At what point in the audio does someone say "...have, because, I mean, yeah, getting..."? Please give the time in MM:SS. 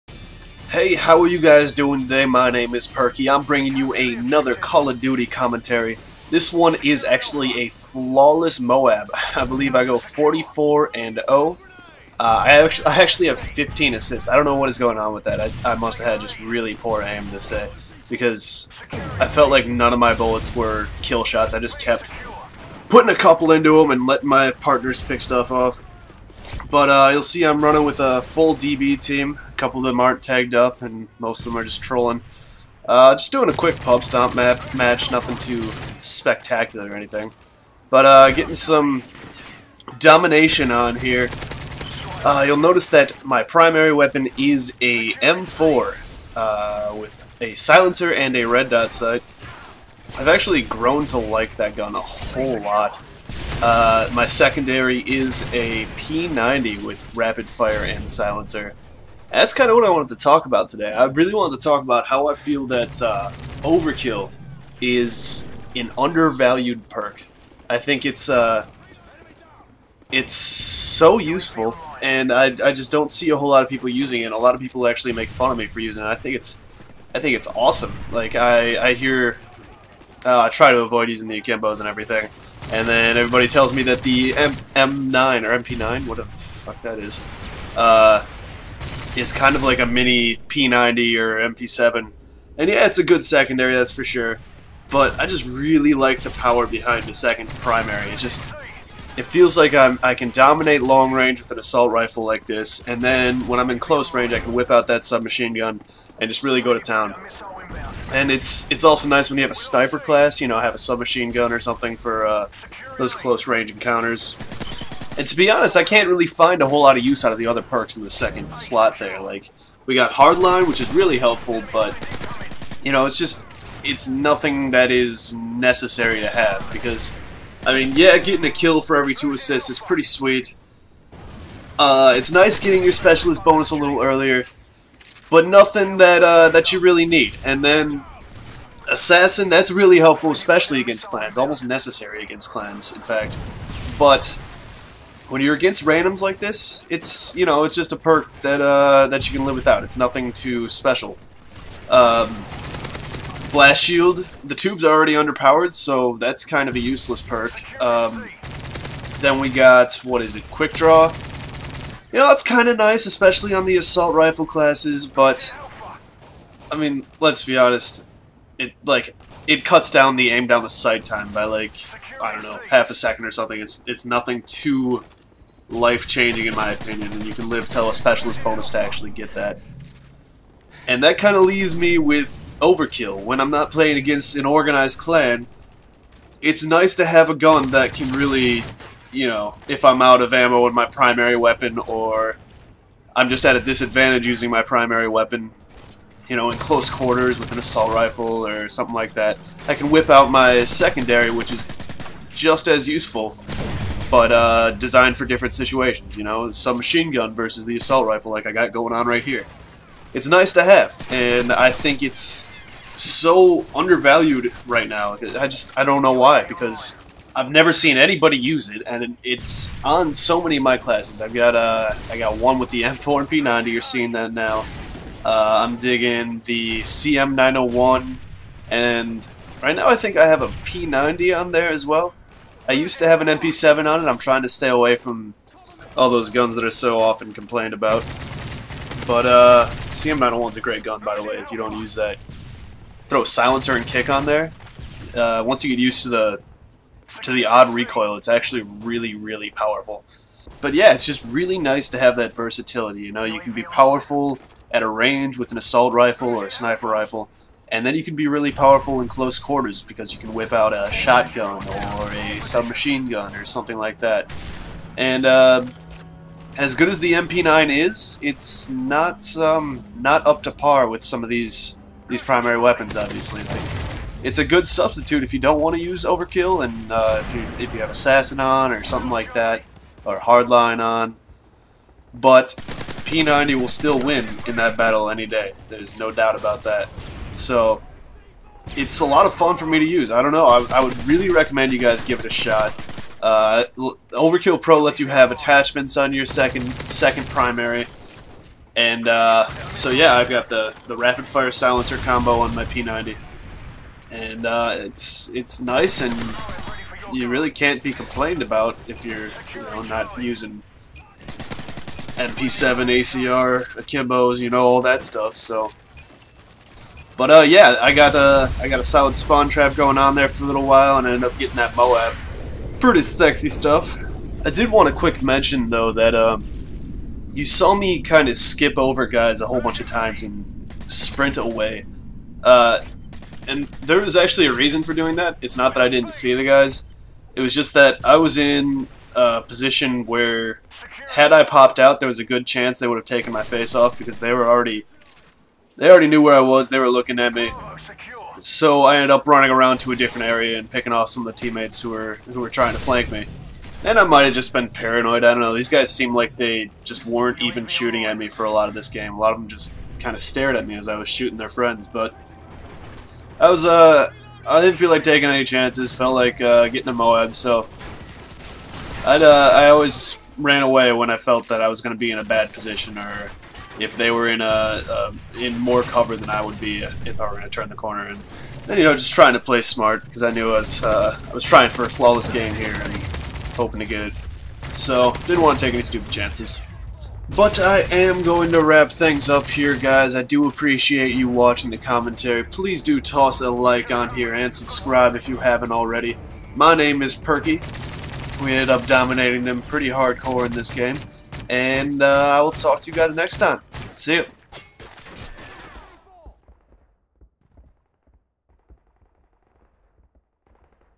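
02:06.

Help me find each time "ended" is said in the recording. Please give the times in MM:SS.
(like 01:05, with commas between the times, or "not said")
05:21, 05:48, 06:38.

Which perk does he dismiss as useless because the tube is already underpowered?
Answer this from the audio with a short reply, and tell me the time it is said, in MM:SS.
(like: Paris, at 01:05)
Blast Shield, at 02:33.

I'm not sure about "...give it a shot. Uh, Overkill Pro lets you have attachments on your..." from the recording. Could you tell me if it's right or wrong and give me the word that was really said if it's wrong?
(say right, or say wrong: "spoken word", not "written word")
right.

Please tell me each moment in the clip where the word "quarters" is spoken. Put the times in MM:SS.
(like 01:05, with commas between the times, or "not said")
03:16, 04:19.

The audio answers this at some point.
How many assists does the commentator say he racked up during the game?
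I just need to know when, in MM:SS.
00:13.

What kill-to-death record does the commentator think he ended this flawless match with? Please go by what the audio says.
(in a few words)
44 and 0.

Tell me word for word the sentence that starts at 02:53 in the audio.
It's, it's nothing too life-changing in my opinion, and you can live till a specialist bonus to actually get that.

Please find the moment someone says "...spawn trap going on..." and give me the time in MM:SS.
05:19.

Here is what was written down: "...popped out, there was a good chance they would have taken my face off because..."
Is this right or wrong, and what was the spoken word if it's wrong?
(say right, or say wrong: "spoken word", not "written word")
right.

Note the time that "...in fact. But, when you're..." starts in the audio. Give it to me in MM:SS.
02:22.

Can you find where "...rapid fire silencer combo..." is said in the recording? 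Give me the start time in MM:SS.
05:00.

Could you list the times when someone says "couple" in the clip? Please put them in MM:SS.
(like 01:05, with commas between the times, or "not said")
00:23, 00:29.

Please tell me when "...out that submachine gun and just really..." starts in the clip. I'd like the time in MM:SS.
01:44.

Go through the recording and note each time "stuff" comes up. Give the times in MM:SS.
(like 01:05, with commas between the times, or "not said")
00:25, 05:15, 05:23.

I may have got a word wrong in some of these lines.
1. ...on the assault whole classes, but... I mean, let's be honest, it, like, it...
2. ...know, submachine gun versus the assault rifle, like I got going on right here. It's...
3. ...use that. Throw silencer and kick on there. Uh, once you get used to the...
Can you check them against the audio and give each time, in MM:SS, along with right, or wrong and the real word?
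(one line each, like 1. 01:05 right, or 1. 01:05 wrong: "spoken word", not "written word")
1. 02:43 wrong: "rifle", not "whole"
2. 03:26 right
3. 04:01 right.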